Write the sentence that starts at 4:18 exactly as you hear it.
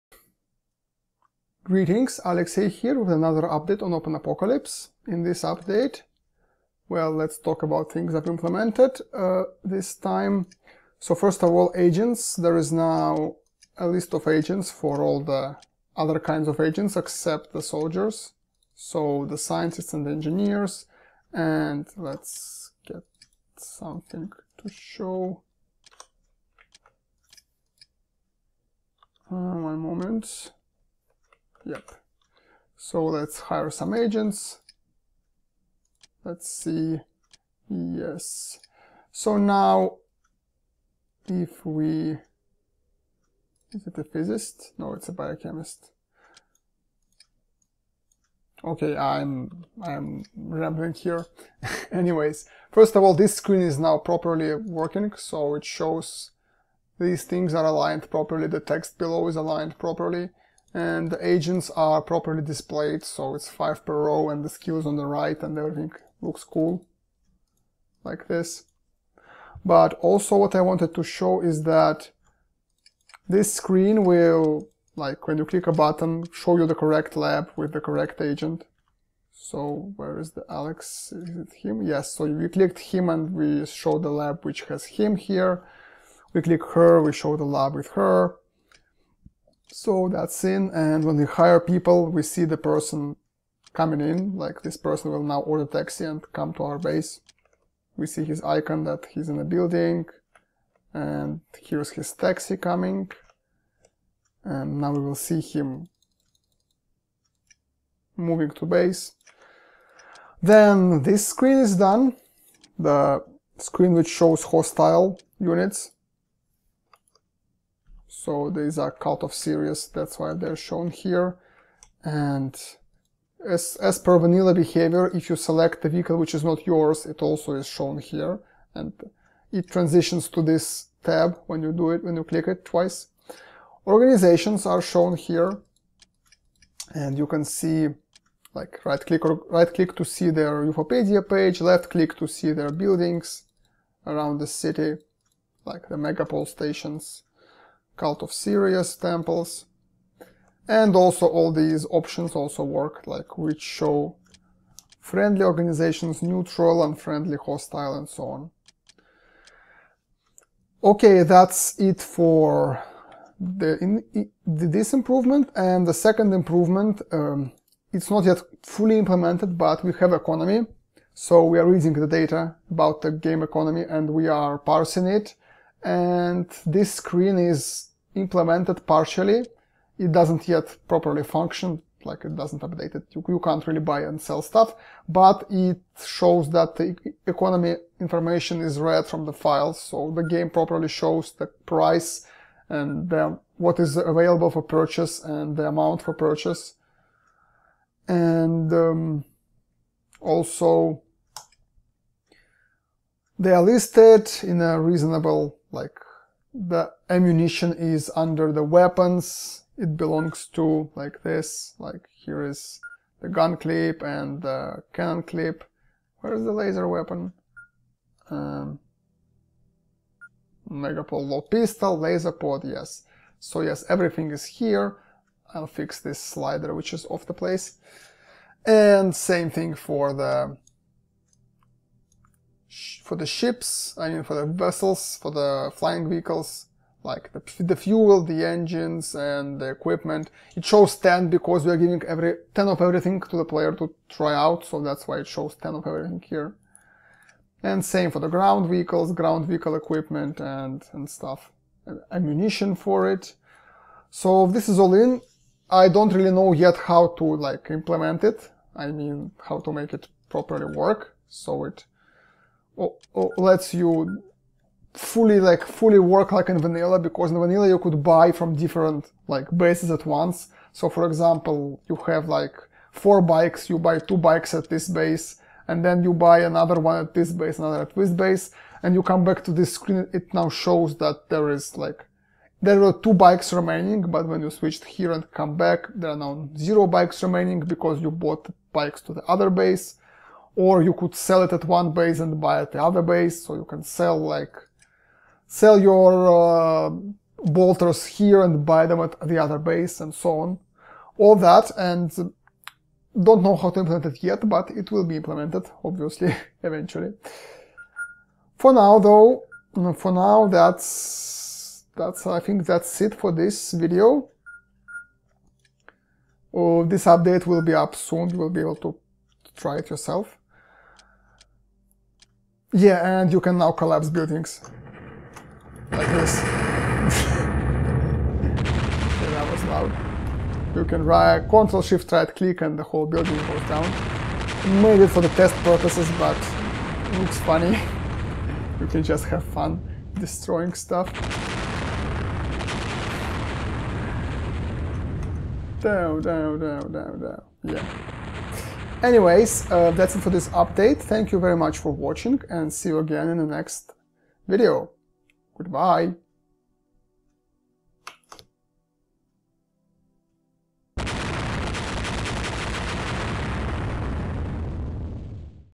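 I mean, how to make it properly work.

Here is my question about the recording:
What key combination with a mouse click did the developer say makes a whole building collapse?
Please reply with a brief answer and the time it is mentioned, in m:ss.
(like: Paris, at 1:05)
Control Shift right click, at 5:31.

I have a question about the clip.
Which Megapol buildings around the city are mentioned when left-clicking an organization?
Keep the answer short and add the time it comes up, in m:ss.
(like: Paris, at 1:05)
Megapol stations, at 2:25.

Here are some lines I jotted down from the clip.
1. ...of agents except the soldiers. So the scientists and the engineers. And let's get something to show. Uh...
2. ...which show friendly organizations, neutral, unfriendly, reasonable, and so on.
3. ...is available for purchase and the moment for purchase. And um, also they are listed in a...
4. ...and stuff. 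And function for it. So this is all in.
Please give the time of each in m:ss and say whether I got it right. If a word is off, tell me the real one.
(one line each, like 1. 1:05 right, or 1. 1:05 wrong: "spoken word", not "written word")
1. 0:16 right
2. 2:33 wrong: "hostile", not "reasonable"
3. 3:13 wrong: "amount", not "moment"
4. 4:10 wrong: "ammunition", not "function".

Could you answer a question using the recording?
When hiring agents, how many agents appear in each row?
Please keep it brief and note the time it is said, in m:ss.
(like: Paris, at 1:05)
5, at 1:03.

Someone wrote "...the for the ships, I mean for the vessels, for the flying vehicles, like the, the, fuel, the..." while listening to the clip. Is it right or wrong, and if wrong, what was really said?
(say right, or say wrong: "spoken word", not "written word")
right.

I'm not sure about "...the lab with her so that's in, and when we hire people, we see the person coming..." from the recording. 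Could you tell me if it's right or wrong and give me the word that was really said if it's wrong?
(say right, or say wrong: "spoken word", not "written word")
right.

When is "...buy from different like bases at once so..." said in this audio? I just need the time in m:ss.
4:28.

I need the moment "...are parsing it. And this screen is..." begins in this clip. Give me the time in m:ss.
2:54.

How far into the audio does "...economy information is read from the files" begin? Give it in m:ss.
3:07.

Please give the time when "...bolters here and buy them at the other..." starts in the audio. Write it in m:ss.
4:57.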